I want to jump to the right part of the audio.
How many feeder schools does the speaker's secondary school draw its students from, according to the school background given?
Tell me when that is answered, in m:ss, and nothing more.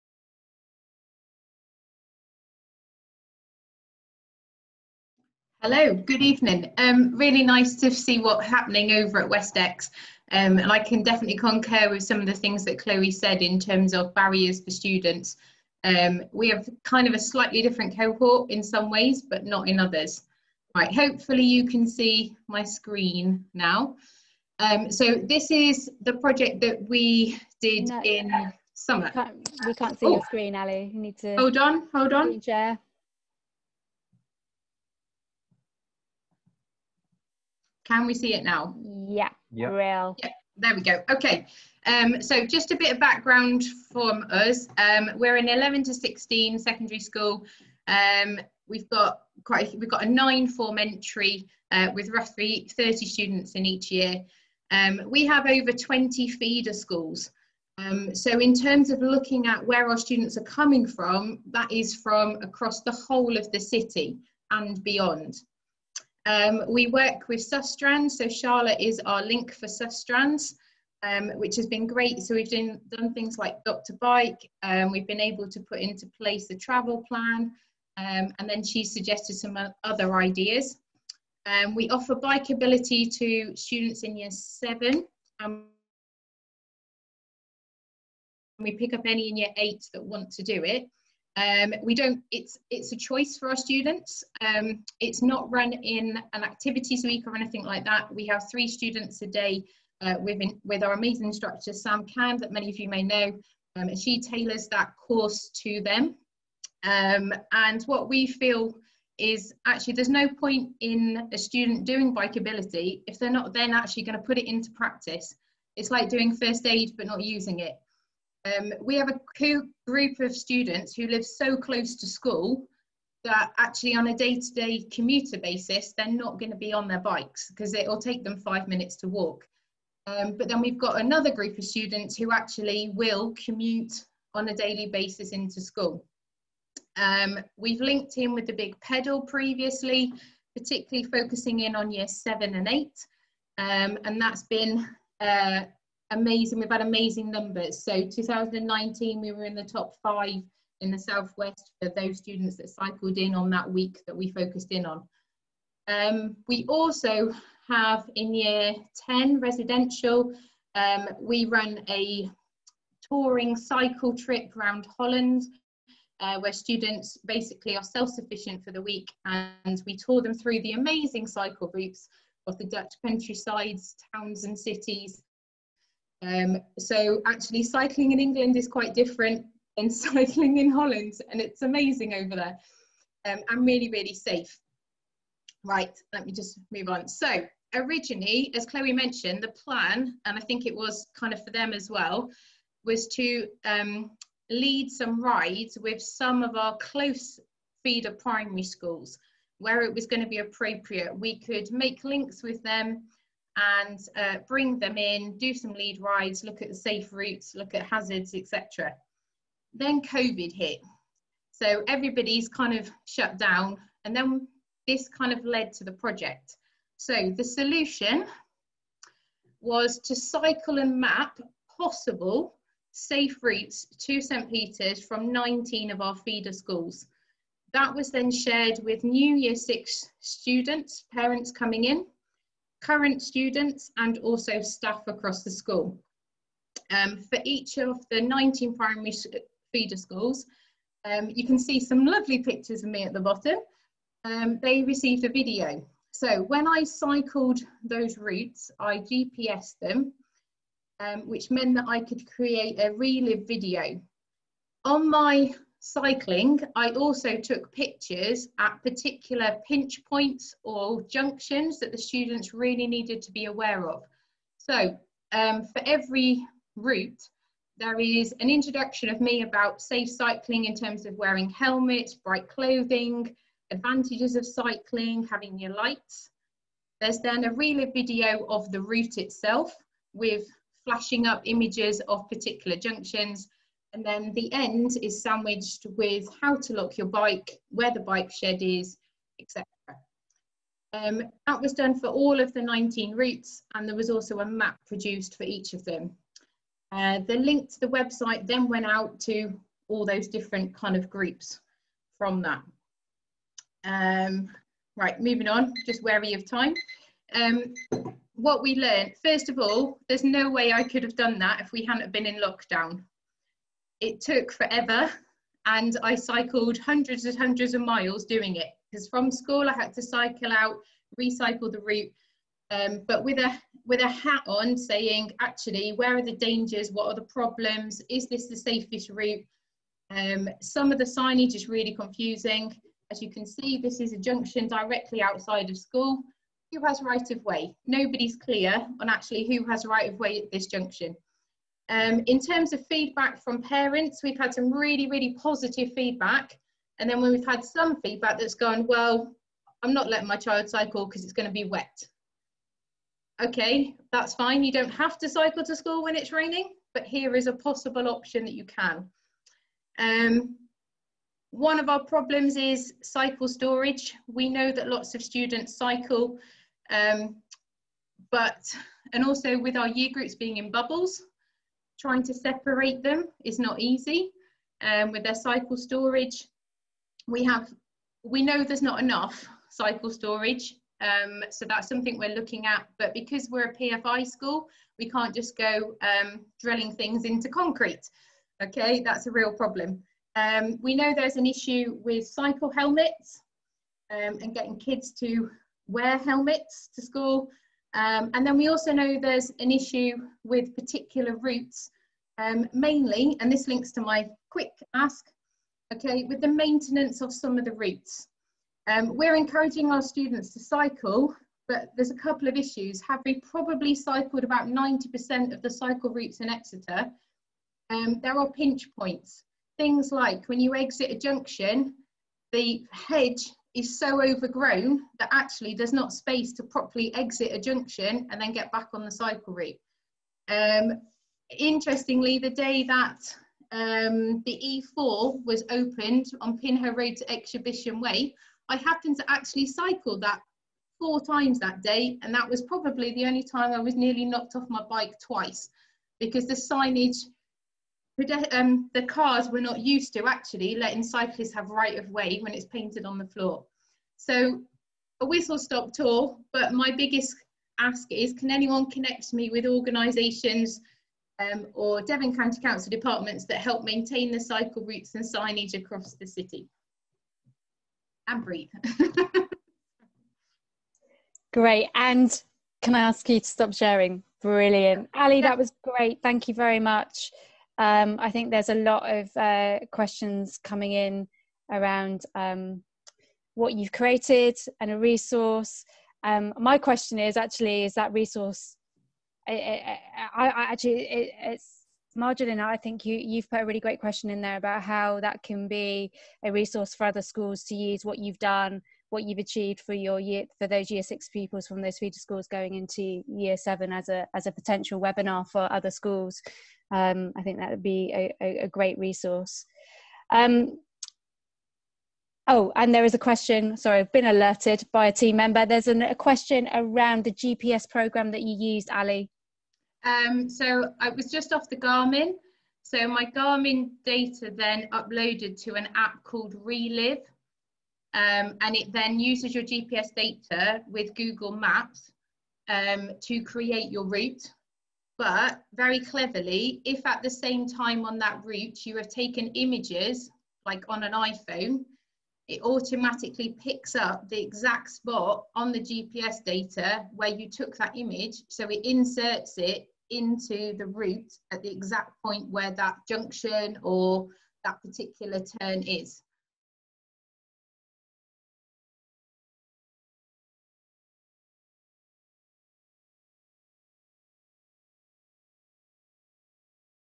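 0:55.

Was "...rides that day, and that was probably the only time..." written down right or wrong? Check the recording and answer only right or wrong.
wrong.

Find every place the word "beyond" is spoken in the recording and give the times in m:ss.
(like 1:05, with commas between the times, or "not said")
1:04.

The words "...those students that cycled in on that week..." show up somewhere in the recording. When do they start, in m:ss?
2:31.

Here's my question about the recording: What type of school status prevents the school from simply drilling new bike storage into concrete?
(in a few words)
PFI.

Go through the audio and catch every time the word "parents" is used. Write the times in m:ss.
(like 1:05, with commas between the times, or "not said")
3:51, 5:43.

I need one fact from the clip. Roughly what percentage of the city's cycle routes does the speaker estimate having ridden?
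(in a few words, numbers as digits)
90%.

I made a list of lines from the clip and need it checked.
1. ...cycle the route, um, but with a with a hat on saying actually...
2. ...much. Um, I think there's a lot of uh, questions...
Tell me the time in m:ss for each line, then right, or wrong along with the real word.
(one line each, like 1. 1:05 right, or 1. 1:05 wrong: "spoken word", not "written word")
1. 5:21 wrong: "recycle", not "cycle"
2. 7:56 right.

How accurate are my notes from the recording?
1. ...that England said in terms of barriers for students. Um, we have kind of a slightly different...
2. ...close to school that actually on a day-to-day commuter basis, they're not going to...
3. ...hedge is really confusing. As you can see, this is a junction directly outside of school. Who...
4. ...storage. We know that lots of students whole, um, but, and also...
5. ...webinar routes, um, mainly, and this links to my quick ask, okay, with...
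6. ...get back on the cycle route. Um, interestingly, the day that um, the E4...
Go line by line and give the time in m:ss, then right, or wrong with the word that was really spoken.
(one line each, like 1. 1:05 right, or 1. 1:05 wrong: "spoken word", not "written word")
1. 0:12 wrong: "Chloe", not "England"
2. 2:01 right
3. 5:31 wrong: "signage", not "hedge"
4. 6:03 wrong: "cycle", not "whole"
5. 6:40 wrong: "particular", not "webinar"
6. 7:08 right.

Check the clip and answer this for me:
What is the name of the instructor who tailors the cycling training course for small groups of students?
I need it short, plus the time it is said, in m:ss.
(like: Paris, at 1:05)
Sam Cam, at 1:41.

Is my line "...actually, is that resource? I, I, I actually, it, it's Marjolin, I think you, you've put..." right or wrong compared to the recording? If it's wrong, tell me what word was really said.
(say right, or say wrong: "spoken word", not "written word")
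right.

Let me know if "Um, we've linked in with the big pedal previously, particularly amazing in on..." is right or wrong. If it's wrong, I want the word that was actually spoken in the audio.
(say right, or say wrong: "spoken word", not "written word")
wrong: "focusing", not "amazing".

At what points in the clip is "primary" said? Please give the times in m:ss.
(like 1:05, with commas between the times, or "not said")
3:18, 3:58.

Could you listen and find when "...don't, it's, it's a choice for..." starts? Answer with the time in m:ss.
1:31.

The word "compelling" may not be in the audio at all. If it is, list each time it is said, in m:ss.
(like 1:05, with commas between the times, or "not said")
not said.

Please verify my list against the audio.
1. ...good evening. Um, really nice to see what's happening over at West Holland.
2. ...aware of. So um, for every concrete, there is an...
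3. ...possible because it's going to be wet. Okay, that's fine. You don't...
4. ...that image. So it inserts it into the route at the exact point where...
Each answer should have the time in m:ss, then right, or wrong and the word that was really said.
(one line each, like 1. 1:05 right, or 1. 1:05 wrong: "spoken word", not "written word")
1. 0:05 wrong: "Exe", not "Holland"
2. 4:23 wrong: "route", not "concrete"
3. 5:50 wrong: "cycle", not "possible"
4. 9:07 right.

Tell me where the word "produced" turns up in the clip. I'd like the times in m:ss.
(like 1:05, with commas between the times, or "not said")
4:54.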